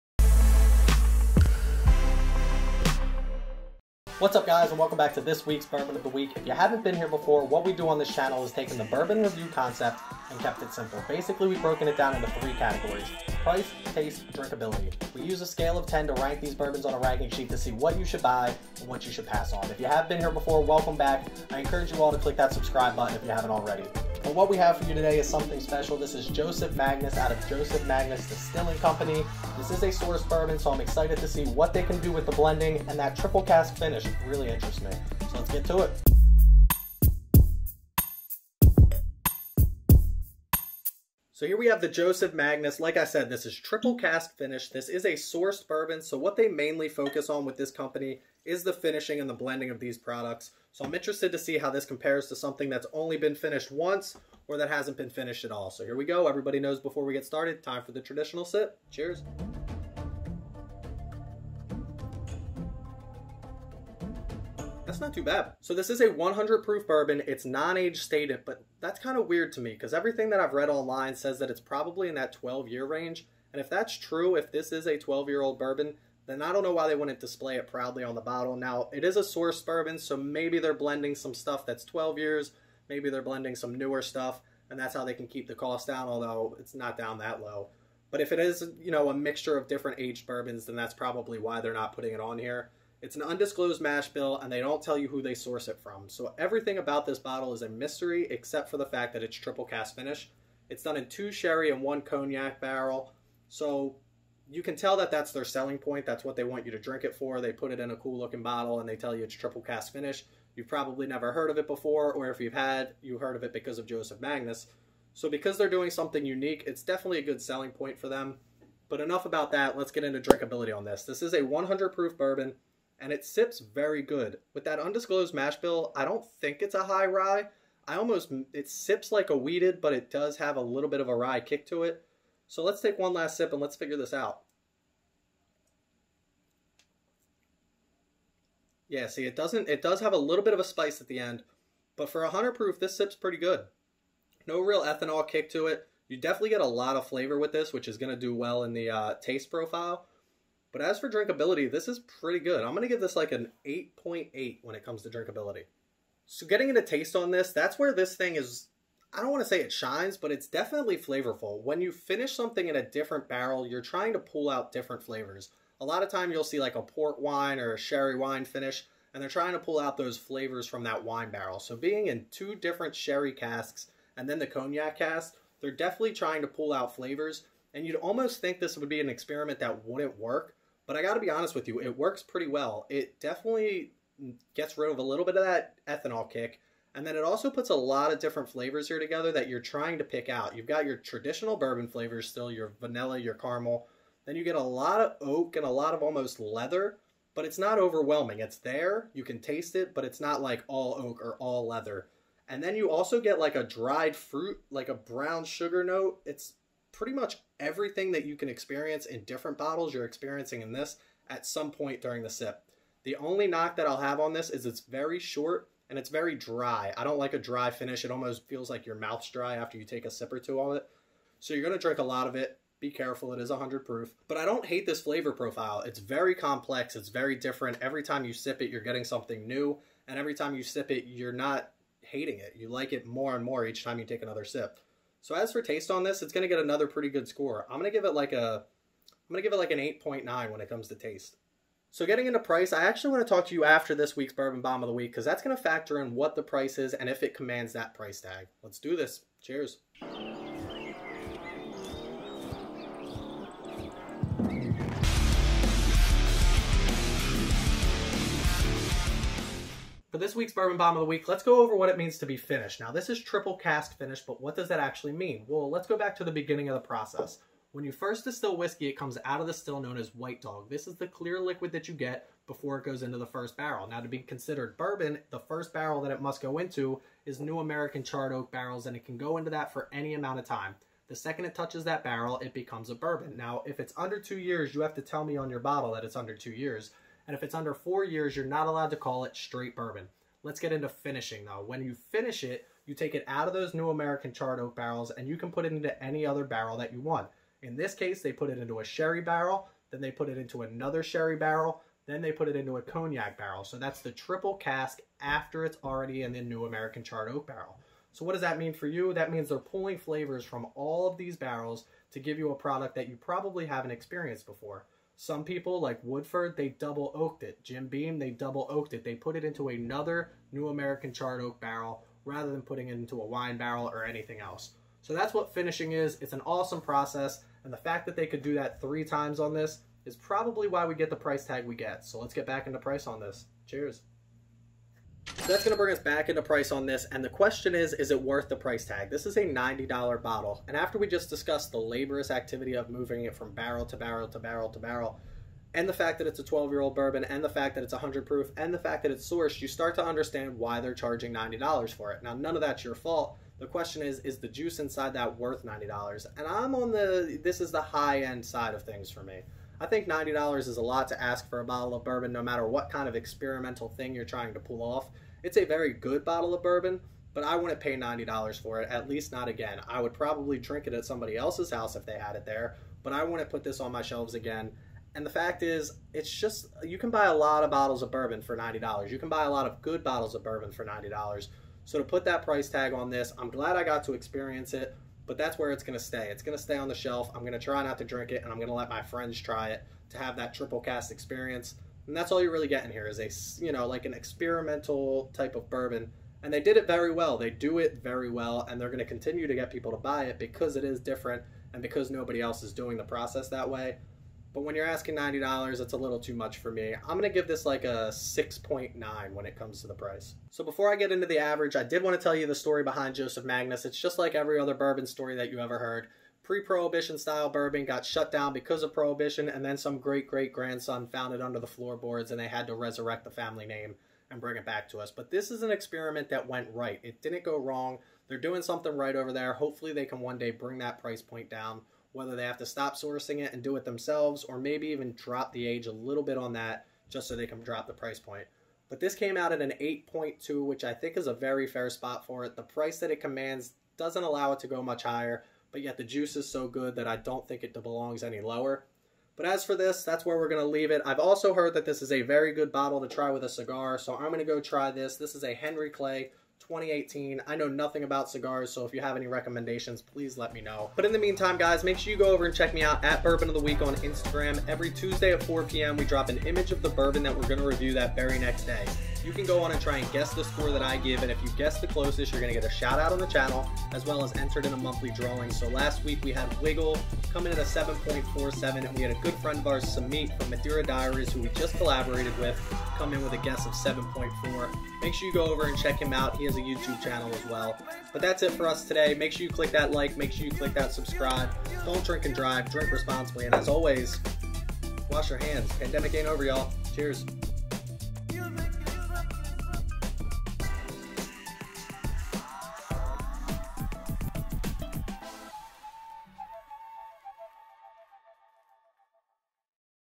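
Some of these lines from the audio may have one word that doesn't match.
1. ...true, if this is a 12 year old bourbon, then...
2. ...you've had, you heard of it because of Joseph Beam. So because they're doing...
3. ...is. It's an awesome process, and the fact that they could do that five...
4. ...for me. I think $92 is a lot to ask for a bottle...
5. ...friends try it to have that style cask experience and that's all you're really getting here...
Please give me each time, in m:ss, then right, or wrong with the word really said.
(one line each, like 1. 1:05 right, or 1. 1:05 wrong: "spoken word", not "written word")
1. 1:13 right
2. 1:52 wrong: "Magnus", not "Beam"
3. 5:25 wrong: "three", not "five"
4. 5:59 wrong: "90", not "92"
5. 6:29 wrong: "triple", not "style".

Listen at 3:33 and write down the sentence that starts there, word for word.
The only knock that I'll have on this is it's very short and it's very dry.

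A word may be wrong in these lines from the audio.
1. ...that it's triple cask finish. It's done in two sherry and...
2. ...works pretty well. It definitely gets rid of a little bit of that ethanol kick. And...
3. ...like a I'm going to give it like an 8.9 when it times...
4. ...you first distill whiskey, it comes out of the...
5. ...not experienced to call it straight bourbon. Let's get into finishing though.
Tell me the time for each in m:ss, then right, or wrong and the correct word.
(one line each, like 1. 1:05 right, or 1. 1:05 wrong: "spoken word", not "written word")
1. 1:39 right
2. 3:01 right
3. 3:58 wrong: "comes", not "times"
4. 4:27 right
5. 4:48 wrong: "allowed", not "experienced".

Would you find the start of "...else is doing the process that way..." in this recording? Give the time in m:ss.
6:42.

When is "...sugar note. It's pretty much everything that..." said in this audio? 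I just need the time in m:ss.
3:25.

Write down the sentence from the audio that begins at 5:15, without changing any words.
Some people, like Woodford, they double oaked it.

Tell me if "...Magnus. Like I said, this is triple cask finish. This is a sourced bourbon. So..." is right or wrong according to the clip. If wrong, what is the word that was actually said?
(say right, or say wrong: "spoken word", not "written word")
right.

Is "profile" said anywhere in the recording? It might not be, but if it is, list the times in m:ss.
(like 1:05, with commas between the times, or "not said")
2:29, 3:45.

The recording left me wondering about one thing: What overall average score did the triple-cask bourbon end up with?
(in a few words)
8.2.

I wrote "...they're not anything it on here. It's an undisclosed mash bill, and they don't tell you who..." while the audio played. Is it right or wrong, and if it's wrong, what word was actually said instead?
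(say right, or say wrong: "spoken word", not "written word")
wrong: "putting", not "anything".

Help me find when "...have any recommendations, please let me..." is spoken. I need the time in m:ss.
7:39.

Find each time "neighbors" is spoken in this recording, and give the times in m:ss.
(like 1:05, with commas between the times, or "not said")
not said.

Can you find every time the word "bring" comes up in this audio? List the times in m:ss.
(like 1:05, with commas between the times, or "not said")
5:35, 7:04, 7:10.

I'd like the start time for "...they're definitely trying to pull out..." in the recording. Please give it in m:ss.
2:55.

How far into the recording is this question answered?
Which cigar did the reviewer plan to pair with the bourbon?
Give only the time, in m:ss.
7:35.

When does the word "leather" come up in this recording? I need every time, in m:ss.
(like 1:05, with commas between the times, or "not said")
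3:16, 3:21.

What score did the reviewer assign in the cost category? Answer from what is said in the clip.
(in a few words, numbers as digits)
6.9.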